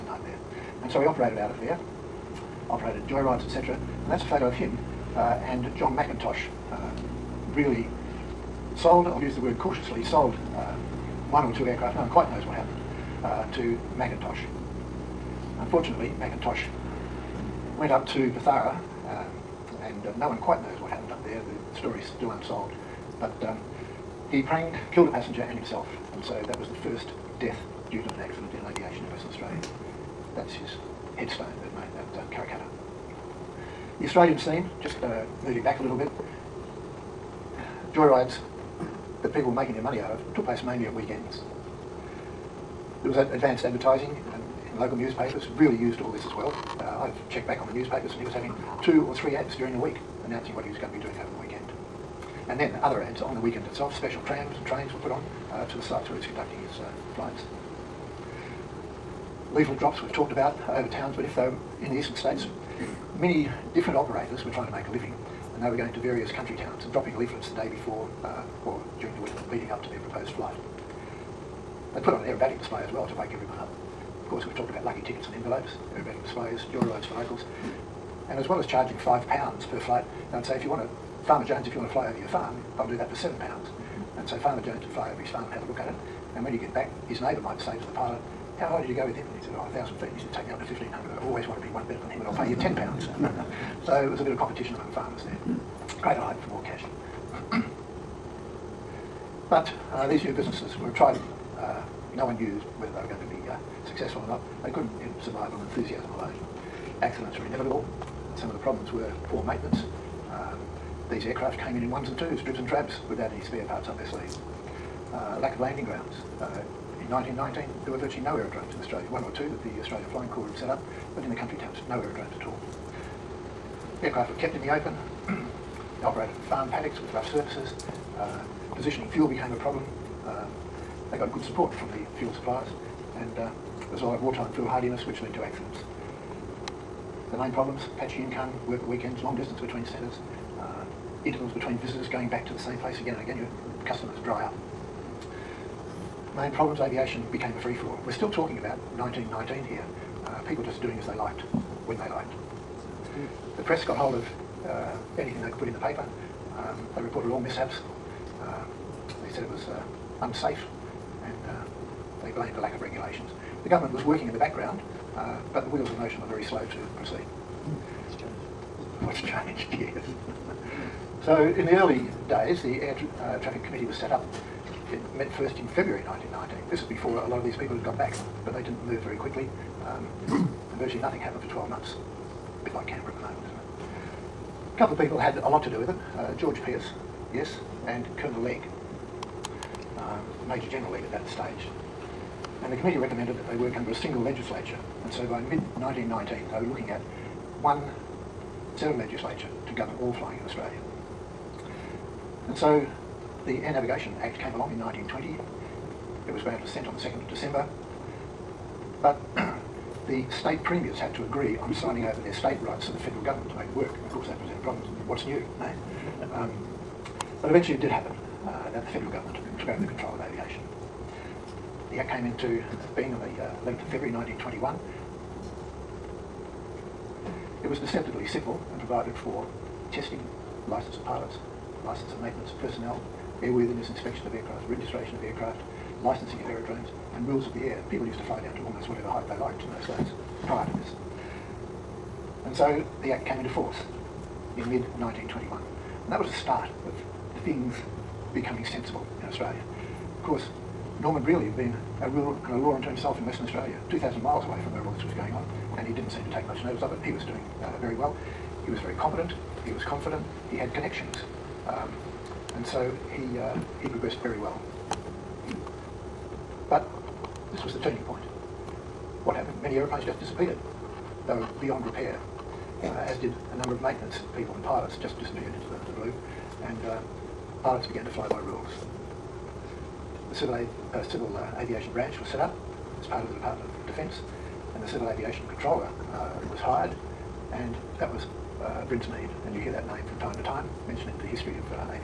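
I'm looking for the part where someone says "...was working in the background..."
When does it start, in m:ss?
2:43.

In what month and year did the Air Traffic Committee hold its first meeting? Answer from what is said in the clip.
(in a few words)
February 1919.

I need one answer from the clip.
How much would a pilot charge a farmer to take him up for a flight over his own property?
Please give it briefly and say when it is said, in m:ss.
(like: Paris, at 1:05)
7 pounds, at 1:23.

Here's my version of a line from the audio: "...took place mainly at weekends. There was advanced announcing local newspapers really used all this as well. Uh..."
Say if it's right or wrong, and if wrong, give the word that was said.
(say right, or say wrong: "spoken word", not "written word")
wrong: "advertising", not "announcing".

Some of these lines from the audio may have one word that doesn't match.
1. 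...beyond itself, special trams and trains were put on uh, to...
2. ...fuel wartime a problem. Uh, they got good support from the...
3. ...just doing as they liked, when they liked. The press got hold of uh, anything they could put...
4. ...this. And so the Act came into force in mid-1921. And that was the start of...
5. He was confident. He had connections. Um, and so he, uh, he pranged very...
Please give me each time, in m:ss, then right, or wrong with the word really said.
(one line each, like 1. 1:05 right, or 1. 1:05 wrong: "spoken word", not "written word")
1. 0:53 wrong: "weekend", not "beyond"
2. 2:09 wrong: "became", not "wartime"
3. 2:30 right
4. 4:00 right
5. 4:19 wrong: "progressed", not "pranged".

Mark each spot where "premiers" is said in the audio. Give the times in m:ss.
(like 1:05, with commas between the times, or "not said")
3:30.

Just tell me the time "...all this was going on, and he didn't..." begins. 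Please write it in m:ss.
4:14.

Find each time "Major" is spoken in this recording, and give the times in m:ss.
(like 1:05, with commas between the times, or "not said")
3:10.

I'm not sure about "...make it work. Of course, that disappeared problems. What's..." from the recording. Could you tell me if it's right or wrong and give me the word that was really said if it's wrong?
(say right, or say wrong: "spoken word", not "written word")
wrong: "presented", not "disappeared".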